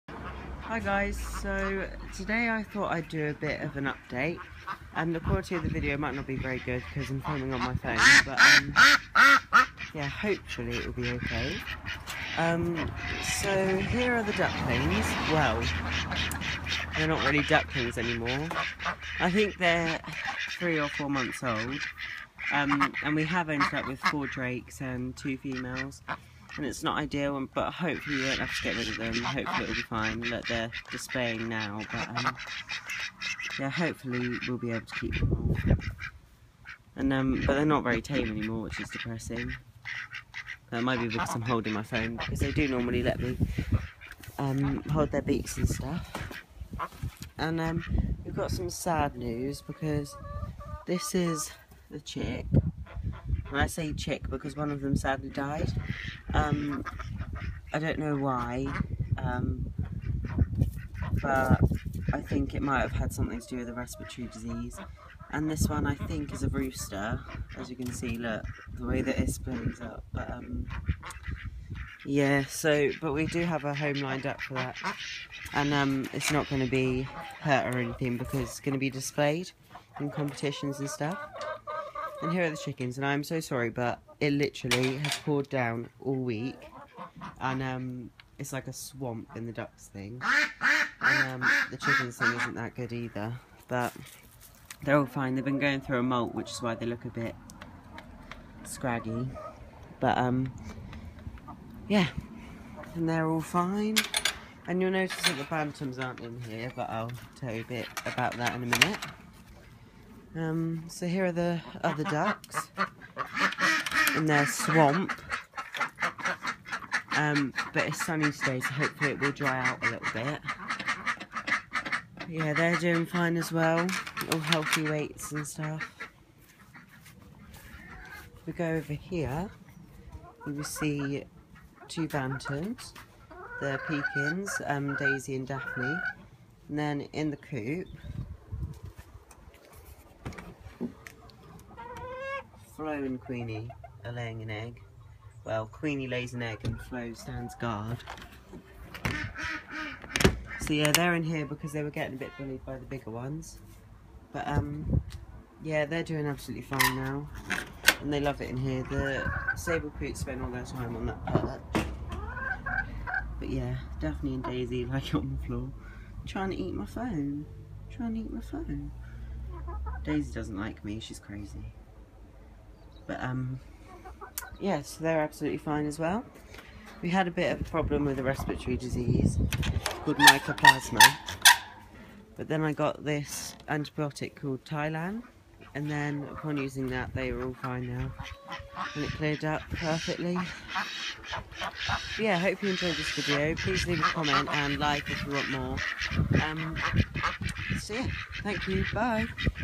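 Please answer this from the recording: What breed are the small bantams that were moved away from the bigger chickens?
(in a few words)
Pekins.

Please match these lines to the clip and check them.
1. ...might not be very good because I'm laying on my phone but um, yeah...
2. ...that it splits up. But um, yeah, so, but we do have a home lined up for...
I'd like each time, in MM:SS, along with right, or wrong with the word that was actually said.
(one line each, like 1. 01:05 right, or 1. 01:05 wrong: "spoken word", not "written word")
1. 00:05 wrong: "filming", not "laying"
2. 01:09 right.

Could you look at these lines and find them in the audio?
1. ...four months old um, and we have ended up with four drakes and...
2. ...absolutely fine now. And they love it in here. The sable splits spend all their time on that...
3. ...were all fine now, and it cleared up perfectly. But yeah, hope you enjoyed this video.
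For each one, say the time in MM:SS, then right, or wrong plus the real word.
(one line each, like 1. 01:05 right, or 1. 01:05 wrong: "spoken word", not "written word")
1. 00:20 right
2. 02:36 wrong: "poots", not "splits"
3. 03:07 right.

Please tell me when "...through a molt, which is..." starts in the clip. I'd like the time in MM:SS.
01:35.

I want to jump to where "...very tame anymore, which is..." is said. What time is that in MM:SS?
00:37.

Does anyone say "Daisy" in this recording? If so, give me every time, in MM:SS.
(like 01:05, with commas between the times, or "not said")
02:14, 02:44, 02:50.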